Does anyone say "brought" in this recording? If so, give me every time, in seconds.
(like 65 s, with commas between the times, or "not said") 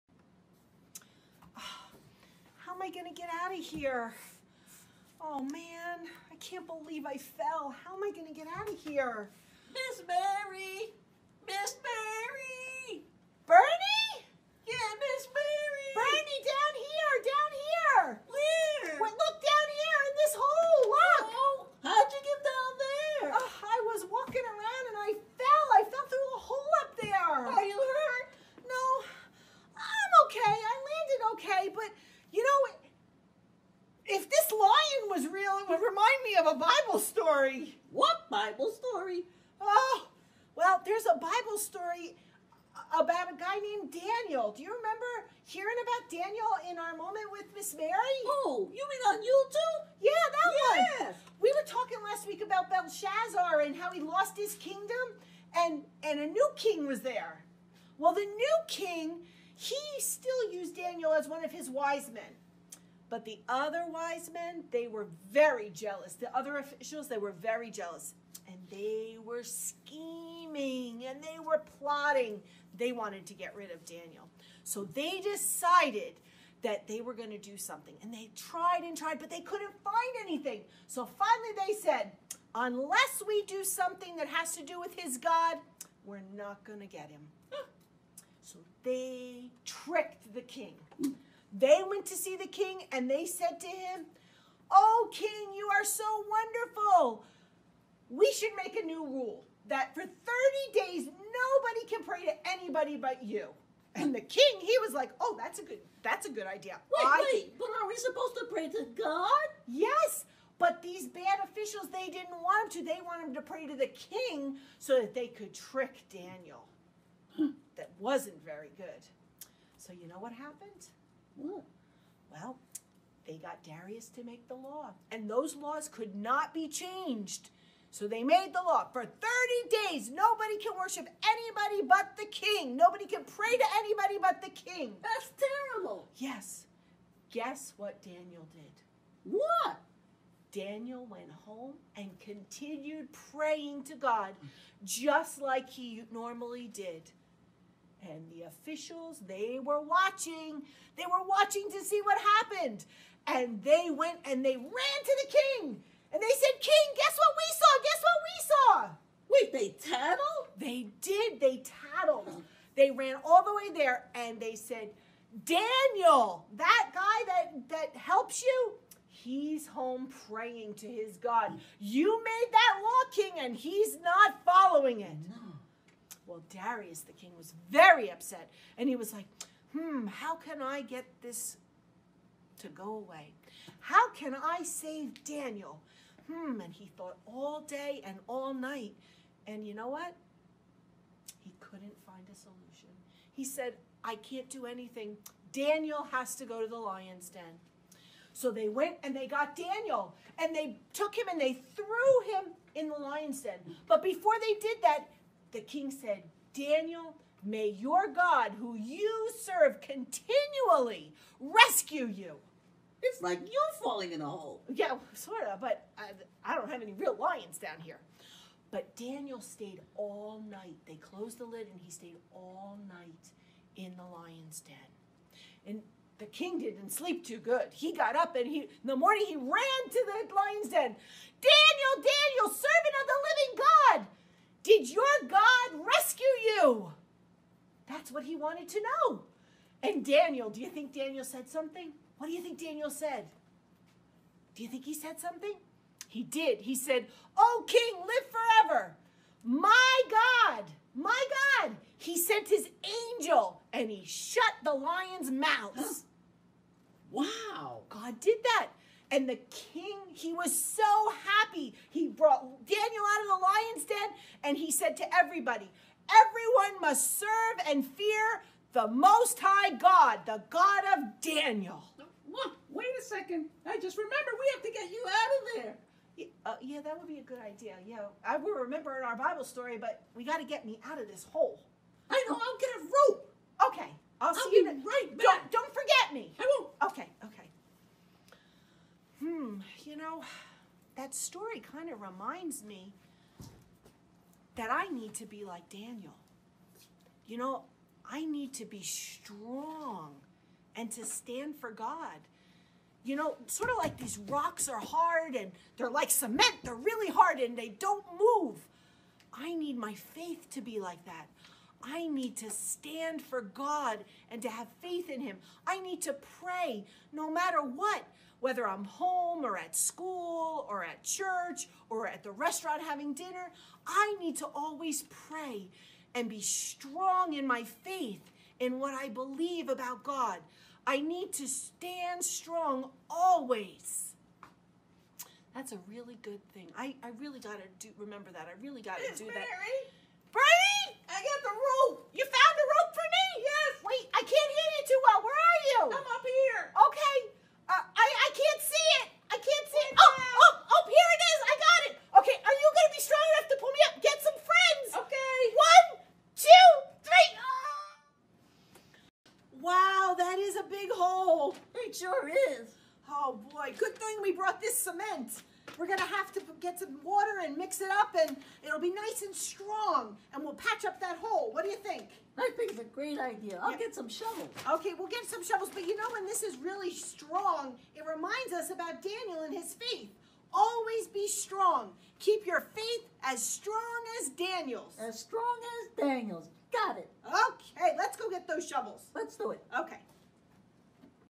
262 s, 364 s.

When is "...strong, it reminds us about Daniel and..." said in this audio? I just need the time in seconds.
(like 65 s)
376 s.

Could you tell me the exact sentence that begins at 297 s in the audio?
You know, I need to be strong and to stand for God.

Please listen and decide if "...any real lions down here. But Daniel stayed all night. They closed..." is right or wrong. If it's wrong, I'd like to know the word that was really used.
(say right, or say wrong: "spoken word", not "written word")
right.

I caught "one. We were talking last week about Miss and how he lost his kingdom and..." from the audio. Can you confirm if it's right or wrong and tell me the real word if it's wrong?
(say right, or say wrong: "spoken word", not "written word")
wrong: "Belshazzar", not "Miss".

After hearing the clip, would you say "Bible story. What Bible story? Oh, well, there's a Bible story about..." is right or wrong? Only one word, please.
right.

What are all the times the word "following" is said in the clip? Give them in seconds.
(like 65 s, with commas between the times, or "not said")
174 s.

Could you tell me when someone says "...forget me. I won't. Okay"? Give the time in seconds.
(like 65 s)
285 s.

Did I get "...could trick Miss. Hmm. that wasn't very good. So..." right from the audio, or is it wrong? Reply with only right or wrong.
wrong.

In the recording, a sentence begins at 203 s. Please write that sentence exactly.
But before they did that, the king said, Daniel, may your God, who you serve continually, rescue you.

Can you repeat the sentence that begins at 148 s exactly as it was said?
And the officials, they were watching.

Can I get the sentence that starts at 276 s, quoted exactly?
Yeah, uh, yeah, that would be a good idea.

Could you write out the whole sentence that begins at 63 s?
But the other wise men, they were very jealous.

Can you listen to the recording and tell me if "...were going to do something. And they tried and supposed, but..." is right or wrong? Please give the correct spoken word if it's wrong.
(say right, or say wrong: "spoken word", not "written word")
wrong: "tried", not "supposed".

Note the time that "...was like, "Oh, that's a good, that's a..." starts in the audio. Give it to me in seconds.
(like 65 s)
104 s.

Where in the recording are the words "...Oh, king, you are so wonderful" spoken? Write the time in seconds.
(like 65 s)
94 s.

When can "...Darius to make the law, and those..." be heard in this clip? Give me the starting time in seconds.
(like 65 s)
123 s.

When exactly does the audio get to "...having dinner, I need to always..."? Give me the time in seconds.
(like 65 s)
322 s.